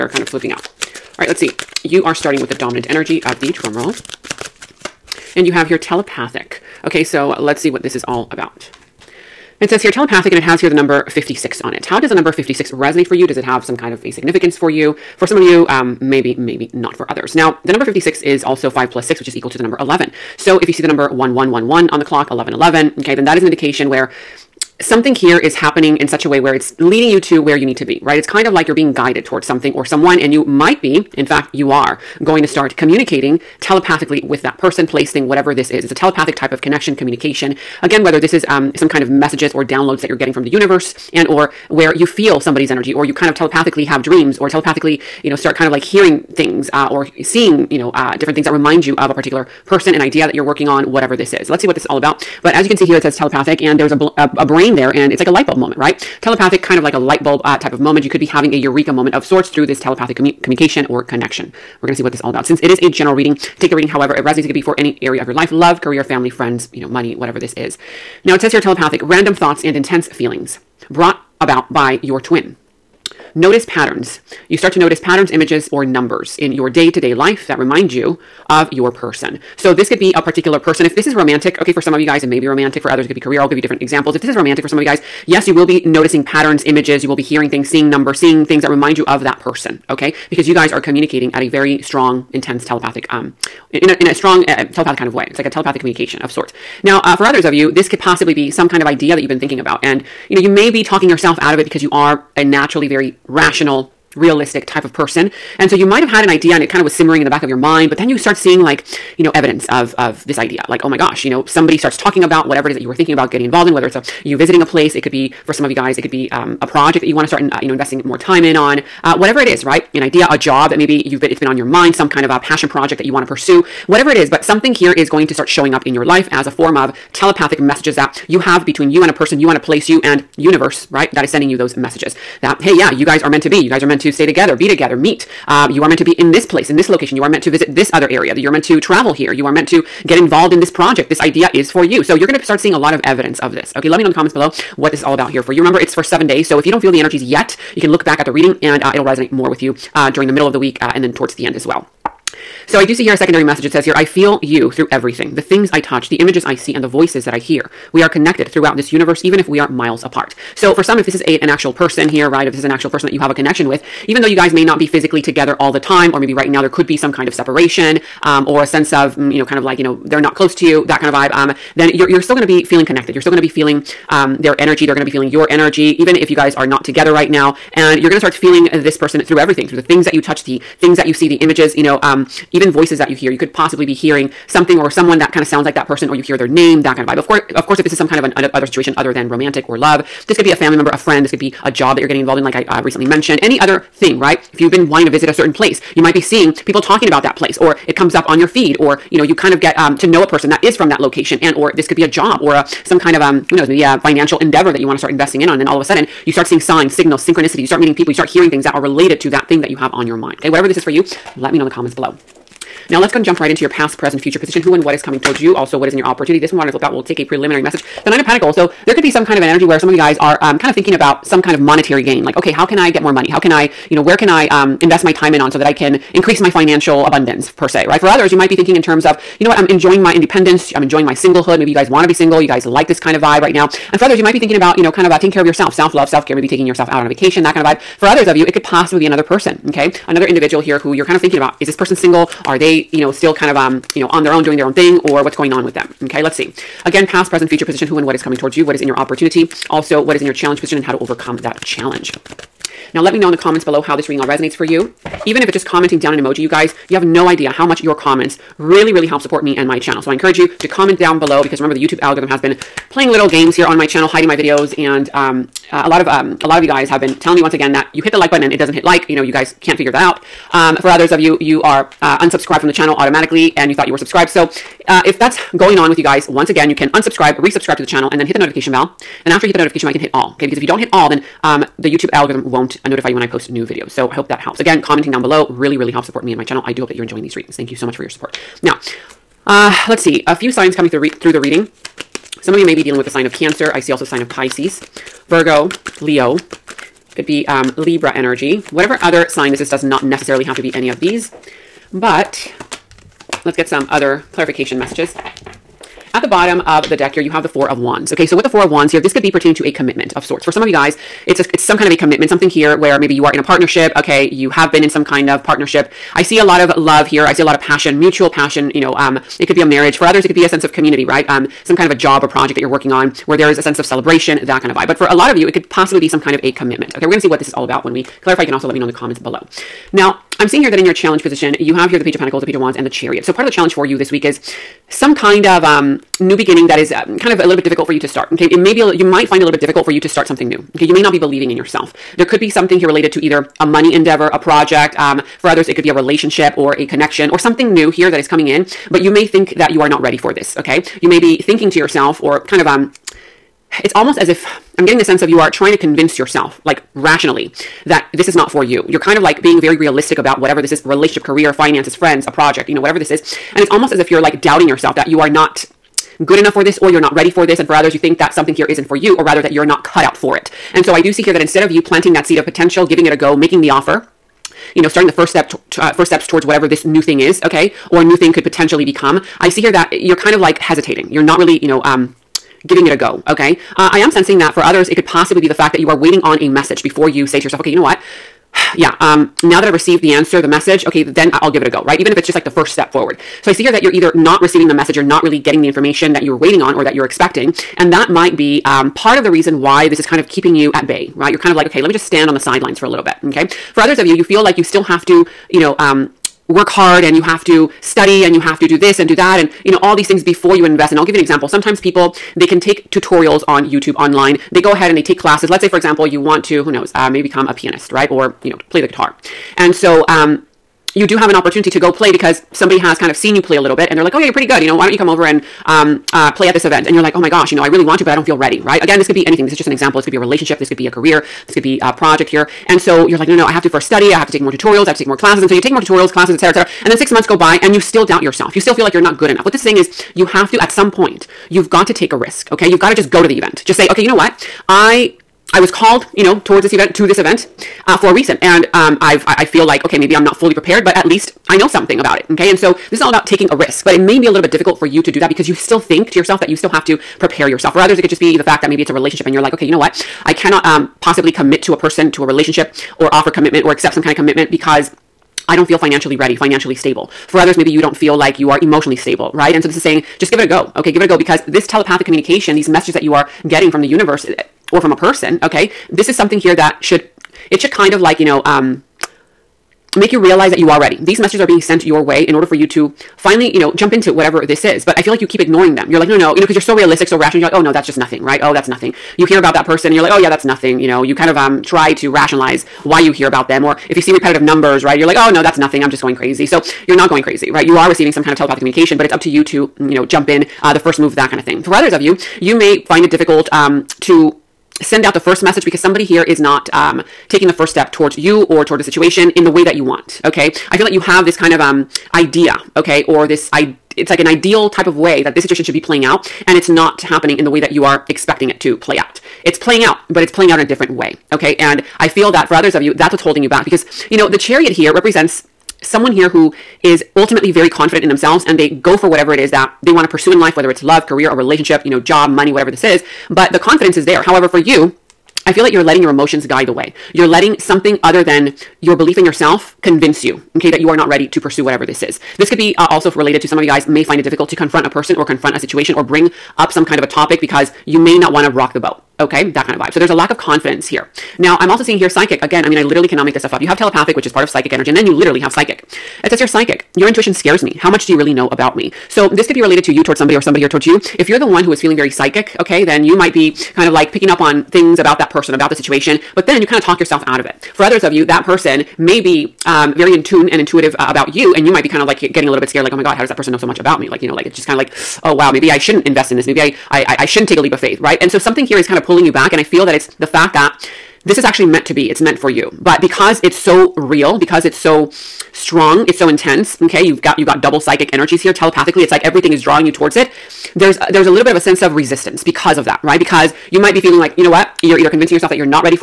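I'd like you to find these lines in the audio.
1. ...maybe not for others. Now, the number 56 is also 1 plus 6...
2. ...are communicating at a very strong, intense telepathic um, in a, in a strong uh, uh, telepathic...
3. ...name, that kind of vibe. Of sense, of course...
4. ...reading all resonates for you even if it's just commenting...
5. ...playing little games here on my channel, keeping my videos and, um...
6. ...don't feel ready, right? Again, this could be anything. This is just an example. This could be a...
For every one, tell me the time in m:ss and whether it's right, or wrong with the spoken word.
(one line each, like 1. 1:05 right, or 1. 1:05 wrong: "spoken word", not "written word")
1. 0:16 wrong: "5", not "1"
2. 1:30 right
3. 3:06 wrong: "course", not "sense"
4. 4:14 right
5. 4:22 wrong: "hiding", not "keeping"
6. 7:08 right.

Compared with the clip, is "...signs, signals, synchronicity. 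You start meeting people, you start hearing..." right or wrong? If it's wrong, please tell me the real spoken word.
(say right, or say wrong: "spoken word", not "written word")
right.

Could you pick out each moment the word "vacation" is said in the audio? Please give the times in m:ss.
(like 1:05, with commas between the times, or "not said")
3:57.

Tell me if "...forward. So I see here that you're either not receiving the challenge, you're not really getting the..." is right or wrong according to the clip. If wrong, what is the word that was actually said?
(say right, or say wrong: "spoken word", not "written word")
wrong: "message", not "challenge".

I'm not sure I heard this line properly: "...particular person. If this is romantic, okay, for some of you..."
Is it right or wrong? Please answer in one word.
right.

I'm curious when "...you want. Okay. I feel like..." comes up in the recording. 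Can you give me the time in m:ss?
8:29.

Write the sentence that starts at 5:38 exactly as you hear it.
Okay, it may be a, you might find it a little bit difficult for you to start something new.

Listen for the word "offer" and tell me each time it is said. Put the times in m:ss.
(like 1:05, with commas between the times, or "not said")
6:13, 7:43.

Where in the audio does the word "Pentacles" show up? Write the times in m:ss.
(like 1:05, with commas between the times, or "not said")
3:38, 5:32.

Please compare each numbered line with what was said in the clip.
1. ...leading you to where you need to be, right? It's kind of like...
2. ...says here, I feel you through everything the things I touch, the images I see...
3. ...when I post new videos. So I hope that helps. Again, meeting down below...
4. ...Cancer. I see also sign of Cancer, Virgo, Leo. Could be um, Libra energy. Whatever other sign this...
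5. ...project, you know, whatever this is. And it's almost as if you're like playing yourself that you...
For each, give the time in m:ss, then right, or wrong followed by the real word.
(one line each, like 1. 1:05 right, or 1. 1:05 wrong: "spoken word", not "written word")
1. 0:26 right
2. 2:33 right
3. 4:43 wrong: "commenting", not "meeting"
4. 4:53 wrong: "Pisces", not "Cancer"
5. 6:02 wrong: "doubting", not "playing".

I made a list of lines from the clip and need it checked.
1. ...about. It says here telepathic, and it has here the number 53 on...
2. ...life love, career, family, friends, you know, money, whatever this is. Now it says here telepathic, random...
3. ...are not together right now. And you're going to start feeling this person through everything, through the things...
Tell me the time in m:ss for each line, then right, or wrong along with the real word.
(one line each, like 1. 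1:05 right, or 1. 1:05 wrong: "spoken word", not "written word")
1. 0:08 wrong: "56", not "53"
2. 1:05 right
3. 2:56 right.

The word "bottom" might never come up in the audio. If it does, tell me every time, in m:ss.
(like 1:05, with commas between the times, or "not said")
5:06.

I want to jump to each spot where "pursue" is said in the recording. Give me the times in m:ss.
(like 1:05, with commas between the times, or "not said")
2:03, 8:50, 9:01.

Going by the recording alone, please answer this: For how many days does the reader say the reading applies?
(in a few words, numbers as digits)
seven.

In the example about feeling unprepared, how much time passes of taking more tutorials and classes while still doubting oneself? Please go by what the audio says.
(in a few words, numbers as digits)
six months.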